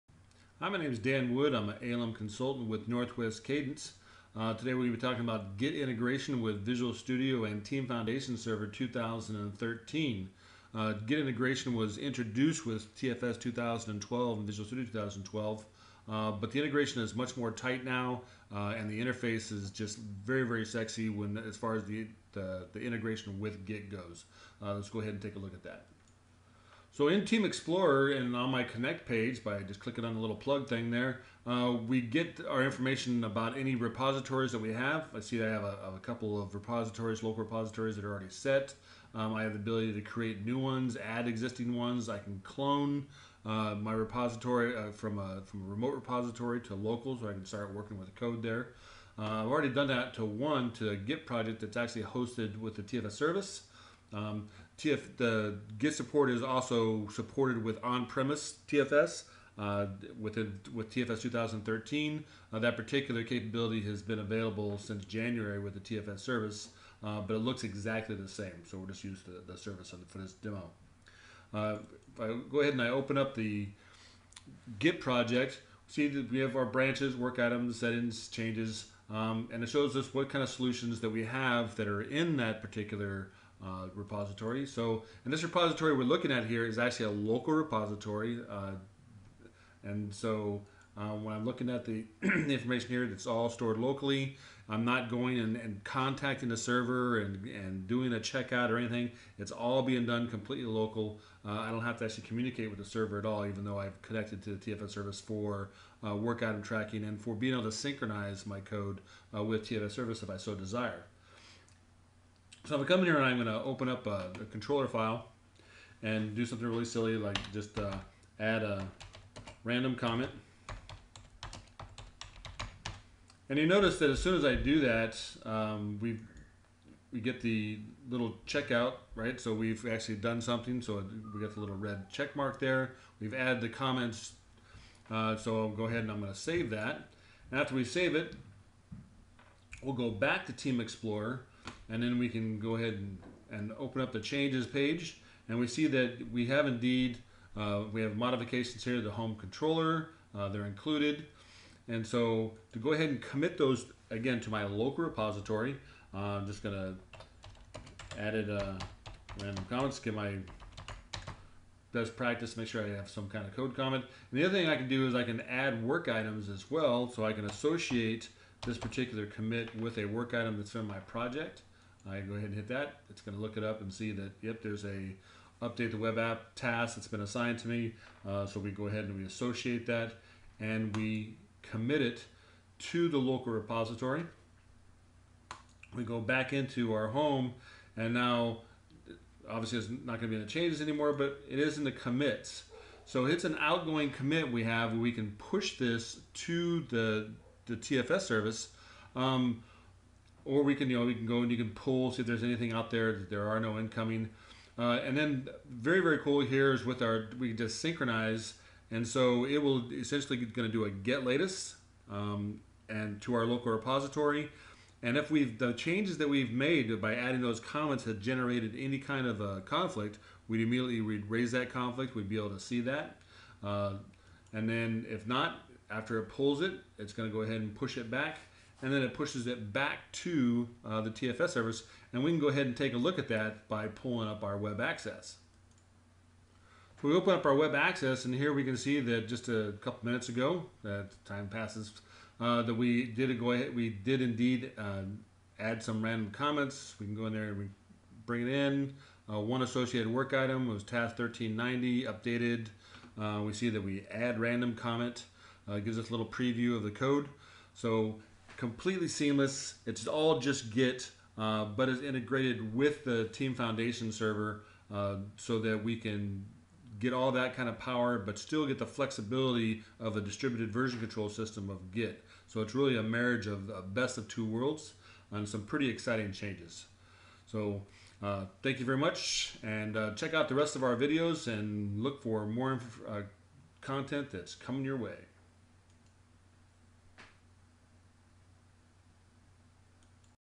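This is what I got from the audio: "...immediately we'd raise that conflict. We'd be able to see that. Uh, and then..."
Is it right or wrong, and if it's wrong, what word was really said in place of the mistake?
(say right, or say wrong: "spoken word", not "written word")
right.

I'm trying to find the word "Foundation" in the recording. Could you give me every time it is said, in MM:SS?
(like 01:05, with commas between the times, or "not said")
00:07, 04:23.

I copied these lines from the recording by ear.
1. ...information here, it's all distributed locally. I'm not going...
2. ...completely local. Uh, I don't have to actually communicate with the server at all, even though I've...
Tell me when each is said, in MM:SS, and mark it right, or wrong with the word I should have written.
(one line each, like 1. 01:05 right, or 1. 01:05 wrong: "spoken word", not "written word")
1. 01:32 wrong: "stored", not "distributed"
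2. 01:40 right.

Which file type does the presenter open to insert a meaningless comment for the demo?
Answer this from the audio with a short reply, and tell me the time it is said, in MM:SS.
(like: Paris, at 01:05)
controller file, at 01:54.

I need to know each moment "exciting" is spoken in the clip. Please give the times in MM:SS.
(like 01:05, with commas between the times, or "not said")
04:35.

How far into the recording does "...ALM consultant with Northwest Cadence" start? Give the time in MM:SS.
00:01.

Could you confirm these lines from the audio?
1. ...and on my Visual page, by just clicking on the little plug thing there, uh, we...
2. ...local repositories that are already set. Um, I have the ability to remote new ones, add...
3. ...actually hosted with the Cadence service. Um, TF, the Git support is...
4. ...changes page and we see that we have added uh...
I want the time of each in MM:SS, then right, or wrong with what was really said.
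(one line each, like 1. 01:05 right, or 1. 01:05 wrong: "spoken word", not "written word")
1. 00:28 wrong: "Connect", not "Visual"
2. 00:37 wrong: "create", not "remote"
3. 00:51 wrong: "TFS", not "Cadence"
4. 02:24 wrong: "indeed", not "added".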